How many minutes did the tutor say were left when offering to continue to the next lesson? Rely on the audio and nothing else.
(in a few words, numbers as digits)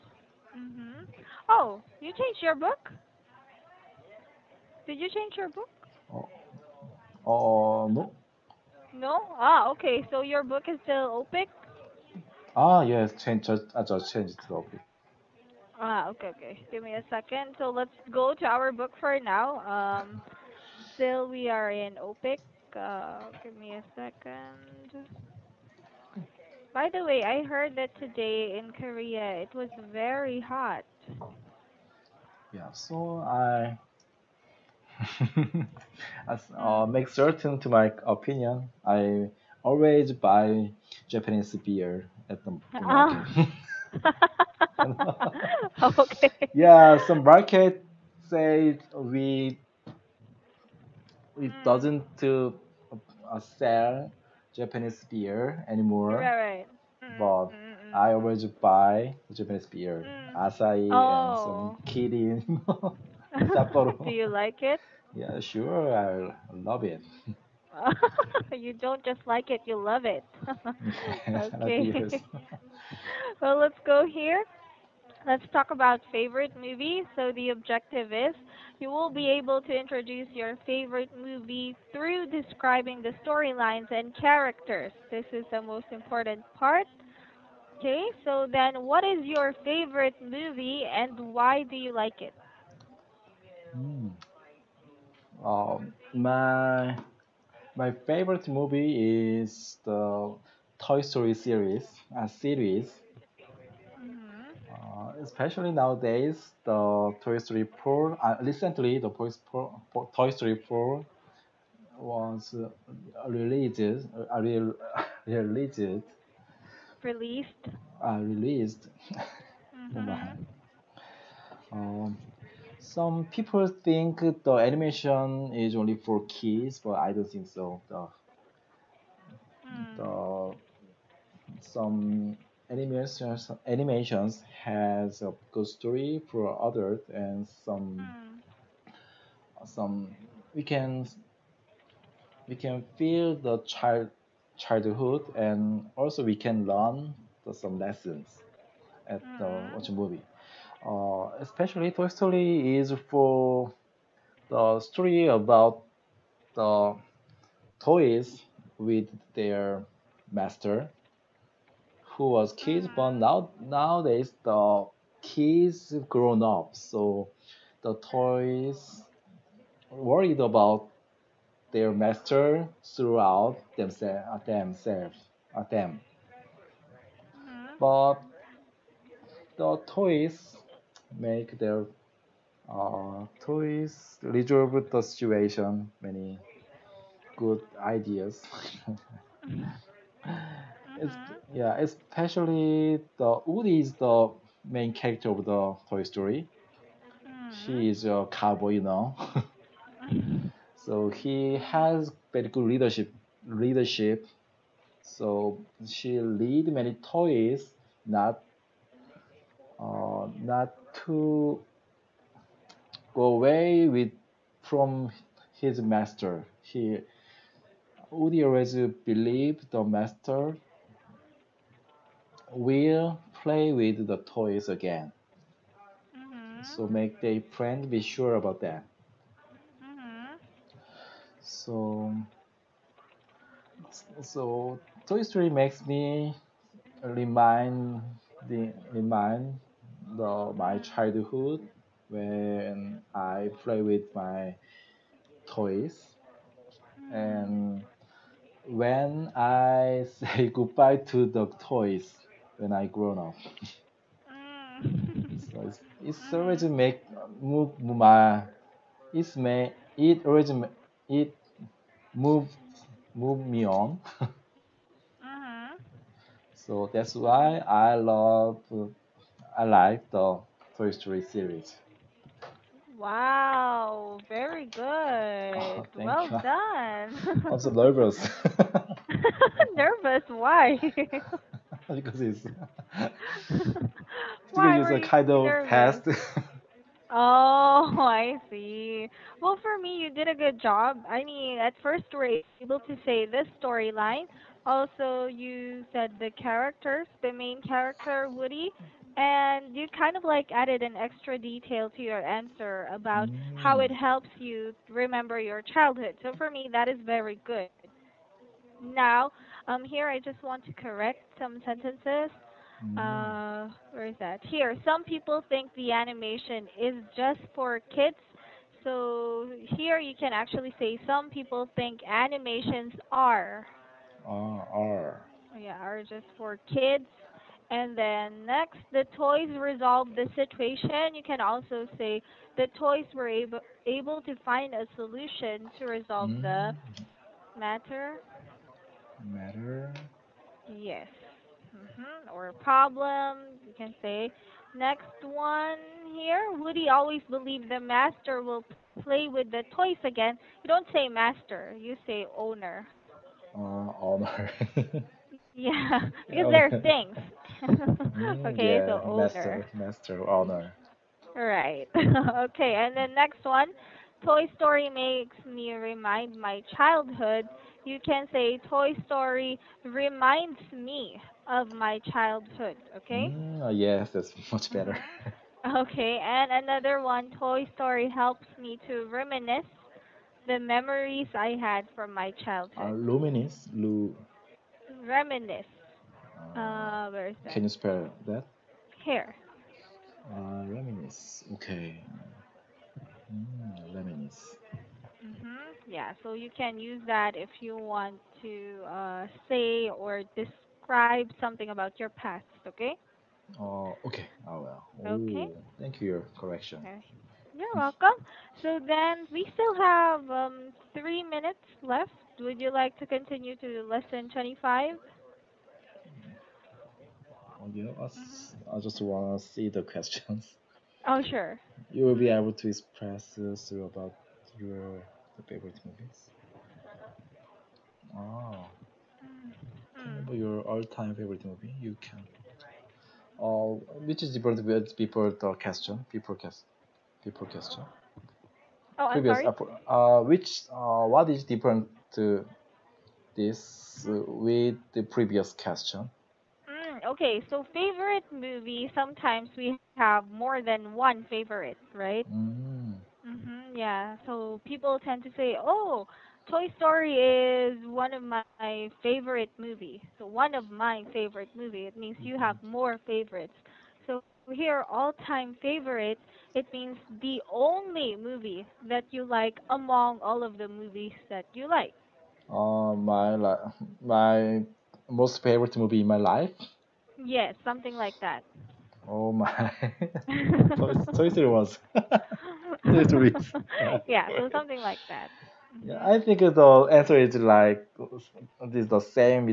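3.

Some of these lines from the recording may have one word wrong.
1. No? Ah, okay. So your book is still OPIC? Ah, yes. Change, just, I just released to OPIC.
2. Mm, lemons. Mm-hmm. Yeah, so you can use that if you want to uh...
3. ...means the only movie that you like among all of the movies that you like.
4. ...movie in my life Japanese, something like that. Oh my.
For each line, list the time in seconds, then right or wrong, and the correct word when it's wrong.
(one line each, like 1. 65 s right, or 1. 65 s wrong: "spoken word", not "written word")
1. 8 s wrong: "changed", not "released"
2. 393 s right
3. 466 s right
4. 475 s wrong: "Yes", not "Japanese".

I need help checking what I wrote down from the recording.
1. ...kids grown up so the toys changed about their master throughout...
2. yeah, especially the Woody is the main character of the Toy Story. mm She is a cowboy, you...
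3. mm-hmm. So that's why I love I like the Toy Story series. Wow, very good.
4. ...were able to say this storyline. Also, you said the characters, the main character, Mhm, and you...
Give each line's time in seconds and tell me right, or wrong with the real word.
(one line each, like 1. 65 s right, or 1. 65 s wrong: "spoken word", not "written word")
1. 165 s wrong: "worried", not "changed"
2. 191 s right
3. 264 s right
4. 292 s wrong: "Woody", not "Mhm".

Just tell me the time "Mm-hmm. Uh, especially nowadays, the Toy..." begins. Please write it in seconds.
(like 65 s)
103 s.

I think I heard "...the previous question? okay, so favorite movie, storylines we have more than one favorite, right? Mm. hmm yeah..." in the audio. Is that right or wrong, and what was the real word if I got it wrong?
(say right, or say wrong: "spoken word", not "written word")
wrong: "sometimes", not "storylines".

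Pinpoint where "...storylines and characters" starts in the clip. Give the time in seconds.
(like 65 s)
83 s.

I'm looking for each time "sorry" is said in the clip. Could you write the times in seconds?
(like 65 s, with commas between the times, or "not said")
439 s.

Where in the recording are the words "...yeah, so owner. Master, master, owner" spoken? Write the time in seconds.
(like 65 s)
358 s.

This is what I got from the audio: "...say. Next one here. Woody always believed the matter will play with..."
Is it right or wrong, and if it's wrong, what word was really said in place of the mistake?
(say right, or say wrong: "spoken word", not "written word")
wrong: "master", not "matter".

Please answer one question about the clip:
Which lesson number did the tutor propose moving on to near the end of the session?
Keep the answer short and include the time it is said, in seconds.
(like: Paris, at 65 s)
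25, at 413 s.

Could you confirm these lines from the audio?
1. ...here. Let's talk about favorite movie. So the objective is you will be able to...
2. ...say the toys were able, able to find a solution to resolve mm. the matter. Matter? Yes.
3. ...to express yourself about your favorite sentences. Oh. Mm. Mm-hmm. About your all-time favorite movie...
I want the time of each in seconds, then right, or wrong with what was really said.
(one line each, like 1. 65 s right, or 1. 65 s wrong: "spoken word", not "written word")
1. 74 s right
2. 331 s right
3. 422 s wrong: "movies", not "sentences".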